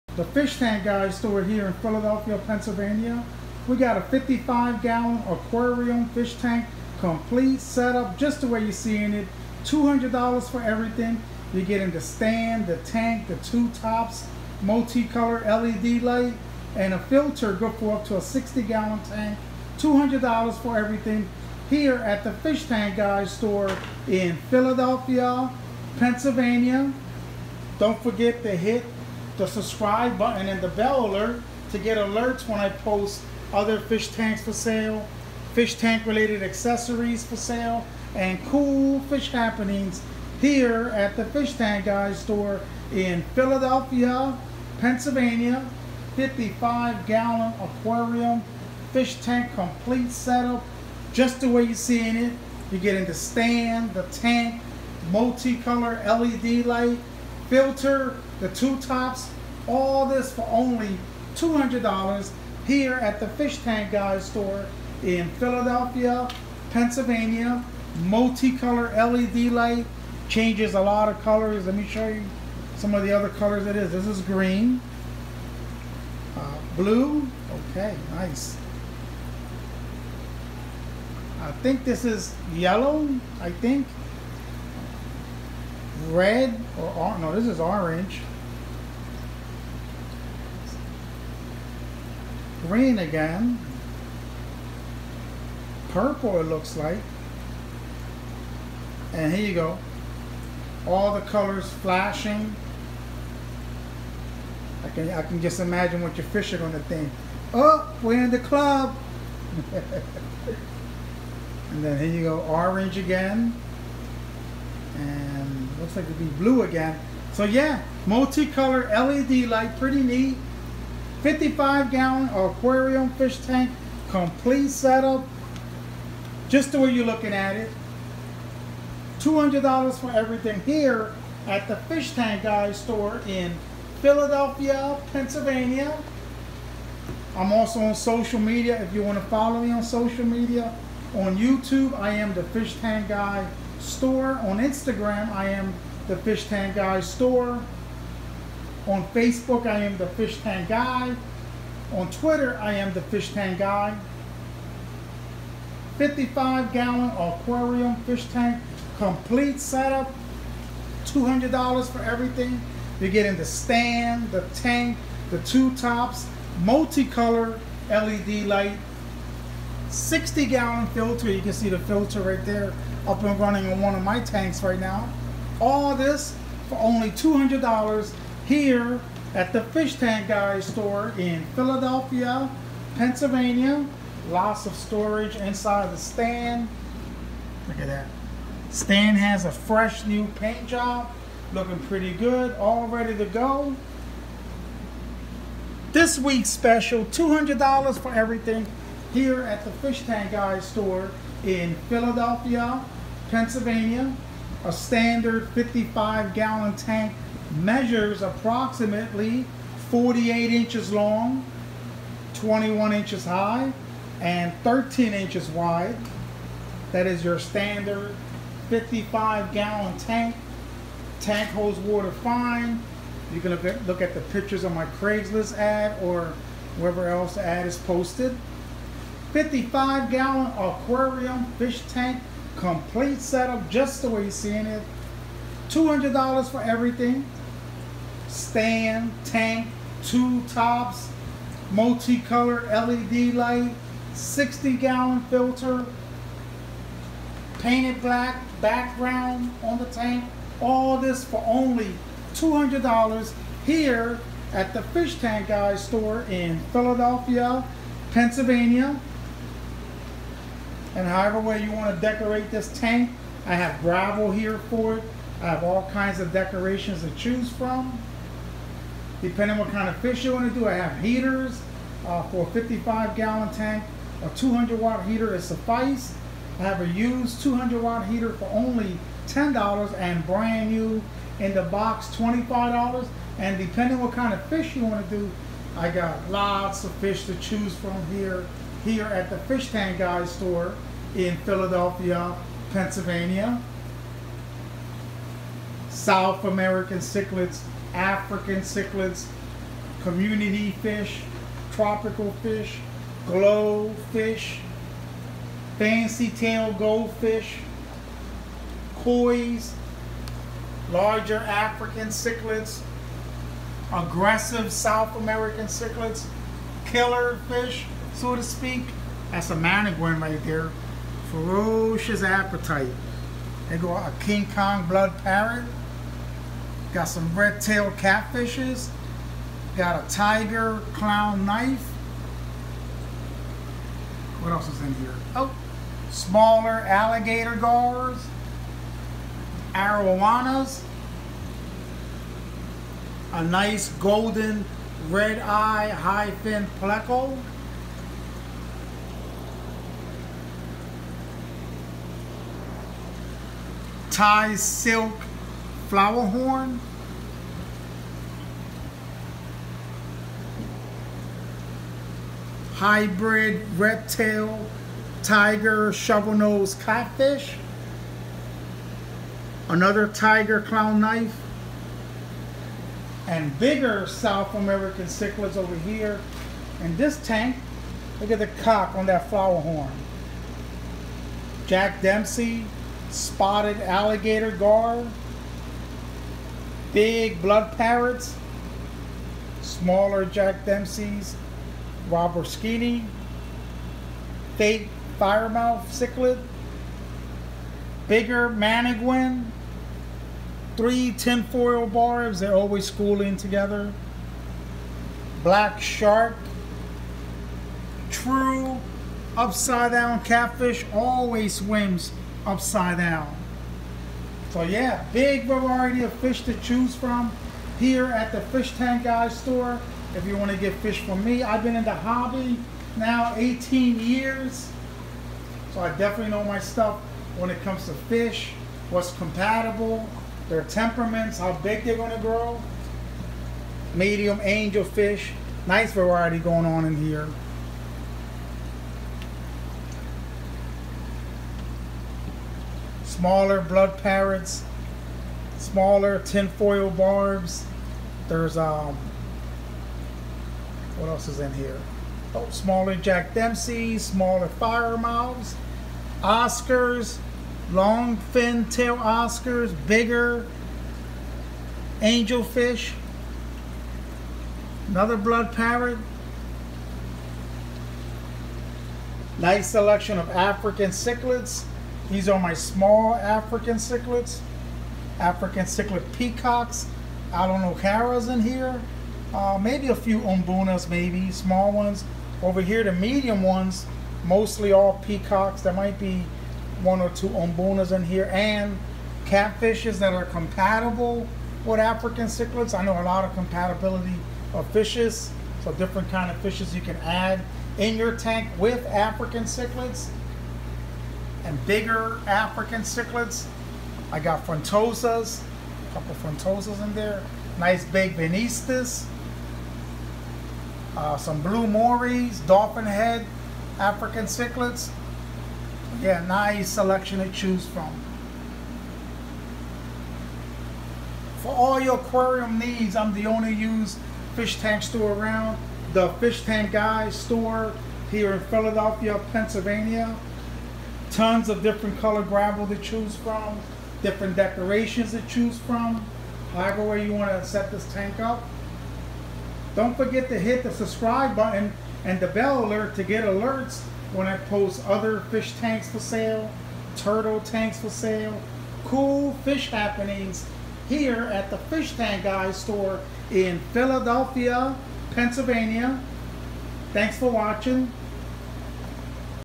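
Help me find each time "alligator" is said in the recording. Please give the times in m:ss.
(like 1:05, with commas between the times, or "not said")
5:36, 6:23.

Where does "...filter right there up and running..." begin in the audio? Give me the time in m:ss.
2:51.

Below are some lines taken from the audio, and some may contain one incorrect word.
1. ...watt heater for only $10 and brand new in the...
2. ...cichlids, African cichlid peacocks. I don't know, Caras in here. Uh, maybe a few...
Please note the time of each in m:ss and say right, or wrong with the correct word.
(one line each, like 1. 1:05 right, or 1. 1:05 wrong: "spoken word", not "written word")
1. 4:37 right
2. 7:53 right.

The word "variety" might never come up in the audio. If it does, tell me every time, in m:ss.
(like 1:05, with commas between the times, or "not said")
6:55, 7:15.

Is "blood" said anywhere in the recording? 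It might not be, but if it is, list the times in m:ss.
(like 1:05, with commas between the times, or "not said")
5:24, 6:27, 7:23, 7:45.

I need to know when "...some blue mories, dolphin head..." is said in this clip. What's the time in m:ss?
8:31.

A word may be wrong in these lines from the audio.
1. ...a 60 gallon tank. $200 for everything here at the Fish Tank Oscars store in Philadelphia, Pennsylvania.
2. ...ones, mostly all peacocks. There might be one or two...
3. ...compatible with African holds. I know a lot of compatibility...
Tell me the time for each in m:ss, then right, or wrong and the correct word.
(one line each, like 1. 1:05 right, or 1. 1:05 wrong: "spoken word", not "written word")
1. 0:18 wrong: "Guys", not "Oscars"
2. 8:03 right
3. 8:10 wrong: "cichlids", not "holds".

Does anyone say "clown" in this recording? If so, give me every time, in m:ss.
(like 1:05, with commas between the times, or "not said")
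5:30, 6:10.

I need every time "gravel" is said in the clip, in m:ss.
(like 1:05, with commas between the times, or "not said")
4:23, 8:52.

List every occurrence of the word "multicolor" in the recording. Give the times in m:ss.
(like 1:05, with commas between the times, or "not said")
0:14, 0:55, 1:08, 1:58, 2:46, 4:01.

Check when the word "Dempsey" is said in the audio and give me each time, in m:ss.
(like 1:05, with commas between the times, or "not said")
6:22, 6:30, 7:33.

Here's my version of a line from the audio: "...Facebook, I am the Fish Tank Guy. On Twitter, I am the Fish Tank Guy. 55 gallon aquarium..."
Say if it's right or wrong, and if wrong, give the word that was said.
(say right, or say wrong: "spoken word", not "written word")
right.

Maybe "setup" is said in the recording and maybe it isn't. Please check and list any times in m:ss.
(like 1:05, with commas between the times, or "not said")
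0:07, 0:50, 2:04, 2:39, 3:53.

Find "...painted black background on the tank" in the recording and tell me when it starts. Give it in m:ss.
4:07.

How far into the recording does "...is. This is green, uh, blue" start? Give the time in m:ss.
1:13.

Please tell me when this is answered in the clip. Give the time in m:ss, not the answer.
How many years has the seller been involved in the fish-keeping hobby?
7:03.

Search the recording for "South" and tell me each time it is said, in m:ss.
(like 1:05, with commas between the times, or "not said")
4:55, 5:14, 6:14.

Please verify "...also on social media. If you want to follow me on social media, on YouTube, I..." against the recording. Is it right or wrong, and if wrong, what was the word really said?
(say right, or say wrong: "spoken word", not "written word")
right.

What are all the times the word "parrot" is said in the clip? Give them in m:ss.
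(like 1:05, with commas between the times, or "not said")
5:25, 6:27, 7:24, 7:45.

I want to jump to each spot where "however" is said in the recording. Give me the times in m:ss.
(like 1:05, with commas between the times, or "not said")
4:21, 8:56.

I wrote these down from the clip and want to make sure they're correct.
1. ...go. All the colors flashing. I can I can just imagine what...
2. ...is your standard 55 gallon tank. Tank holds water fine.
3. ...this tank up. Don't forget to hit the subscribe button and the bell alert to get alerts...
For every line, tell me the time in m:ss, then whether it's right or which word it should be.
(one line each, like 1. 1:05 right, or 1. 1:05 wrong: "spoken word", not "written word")
1. 1:39 right
2. 3:37 right
3. 8:57 right.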